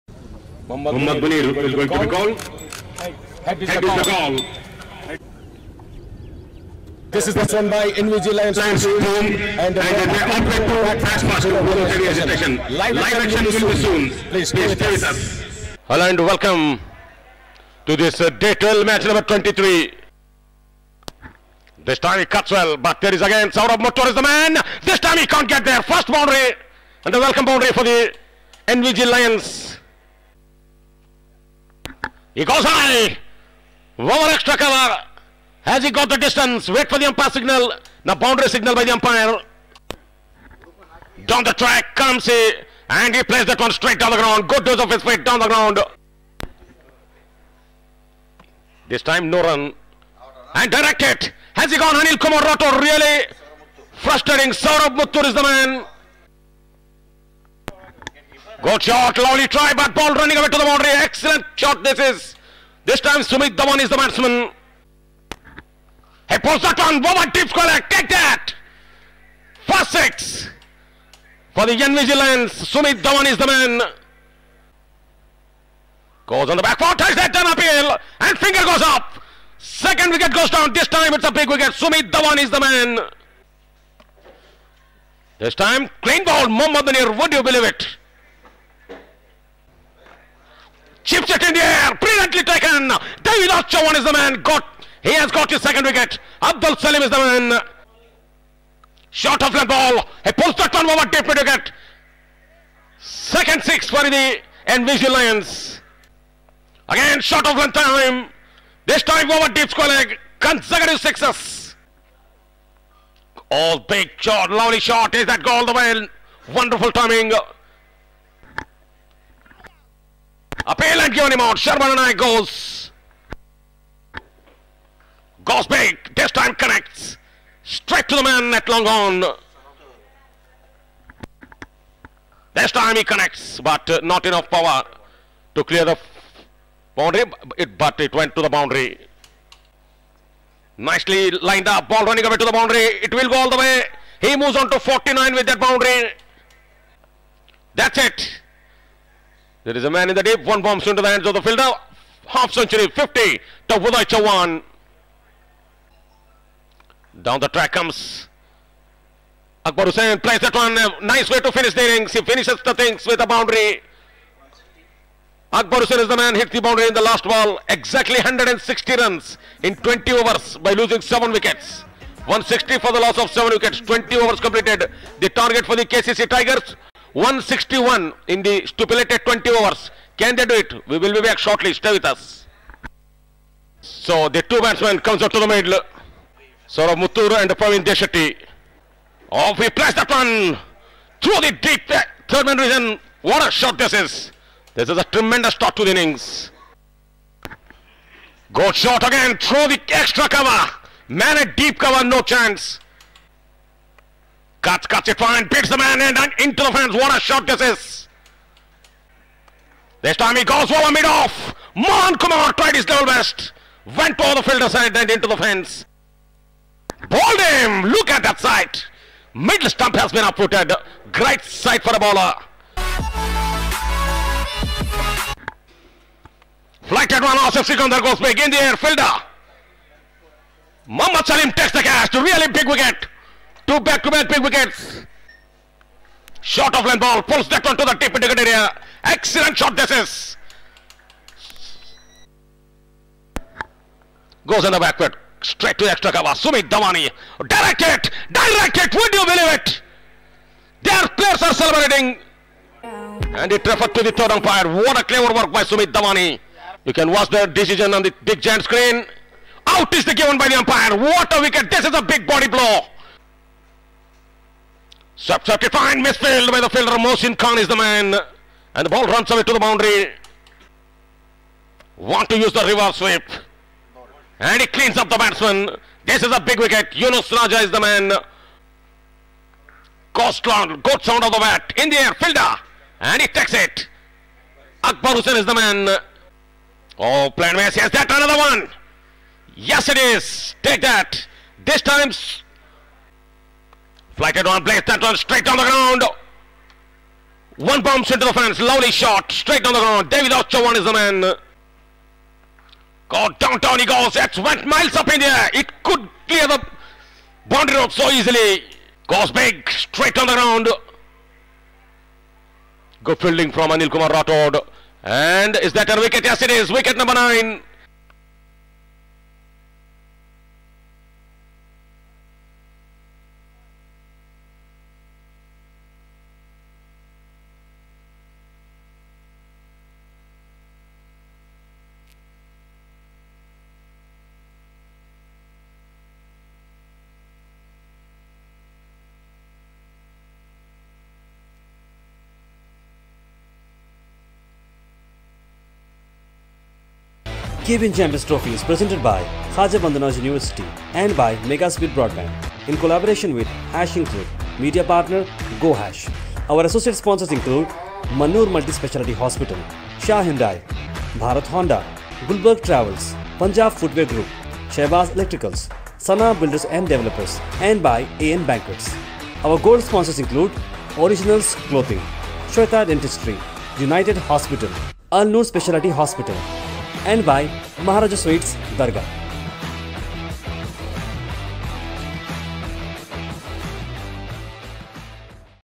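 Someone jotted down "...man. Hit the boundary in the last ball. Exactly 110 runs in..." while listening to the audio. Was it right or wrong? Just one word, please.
wrong.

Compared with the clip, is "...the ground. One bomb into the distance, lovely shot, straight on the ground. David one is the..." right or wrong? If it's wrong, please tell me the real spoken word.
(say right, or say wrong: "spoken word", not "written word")
wrong: "fence", not "distance".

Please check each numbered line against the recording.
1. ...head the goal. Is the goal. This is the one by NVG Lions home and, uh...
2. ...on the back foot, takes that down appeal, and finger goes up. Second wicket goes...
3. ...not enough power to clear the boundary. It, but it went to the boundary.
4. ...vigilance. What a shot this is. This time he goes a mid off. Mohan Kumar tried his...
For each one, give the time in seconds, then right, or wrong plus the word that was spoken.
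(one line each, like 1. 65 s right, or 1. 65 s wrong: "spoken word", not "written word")
1. 3 s right
2. 76 s right
3. 134 s right
4. 206 s wrong: "fence", not "vigilance".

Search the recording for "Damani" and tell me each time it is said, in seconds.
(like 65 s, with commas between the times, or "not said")
246 s, 255 s.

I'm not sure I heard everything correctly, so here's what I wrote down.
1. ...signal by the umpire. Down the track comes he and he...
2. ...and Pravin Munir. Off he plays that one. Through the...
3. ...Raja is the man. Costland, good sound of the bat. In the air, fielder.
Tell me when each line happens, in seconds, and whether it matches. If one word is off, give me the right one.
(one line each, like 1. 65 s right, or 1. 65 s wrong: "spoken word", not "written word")
1. 38 s right
2. 187 s wrong: "Deshetti", not "Munir"
3. 277 s right.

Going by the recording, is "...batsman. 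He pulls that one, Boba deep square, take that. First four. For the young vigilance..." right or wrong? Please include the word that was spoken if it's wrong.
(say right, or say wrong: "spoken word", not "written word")
wrong: "six", not "four".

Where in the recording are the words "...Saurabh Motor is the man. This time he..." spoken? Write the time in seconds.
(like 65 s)
23 s.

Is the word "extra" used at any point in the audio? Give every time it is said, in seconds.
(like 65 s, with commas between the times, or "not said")
34 s, 199 s, 245 s.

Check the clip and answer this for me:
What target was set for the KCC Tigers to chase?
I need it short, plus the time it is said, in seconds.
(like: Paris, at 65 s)
161, at 177 s.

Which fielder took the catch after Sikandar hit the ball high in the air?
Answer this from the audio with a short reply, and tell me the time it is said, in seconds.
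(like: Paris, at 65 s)
Mohammad Salim, at 230 s.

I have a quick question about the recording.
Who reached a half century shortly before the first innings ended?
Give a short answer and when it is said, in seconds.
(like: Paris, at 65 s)
Uday Chauhan, at 153 s.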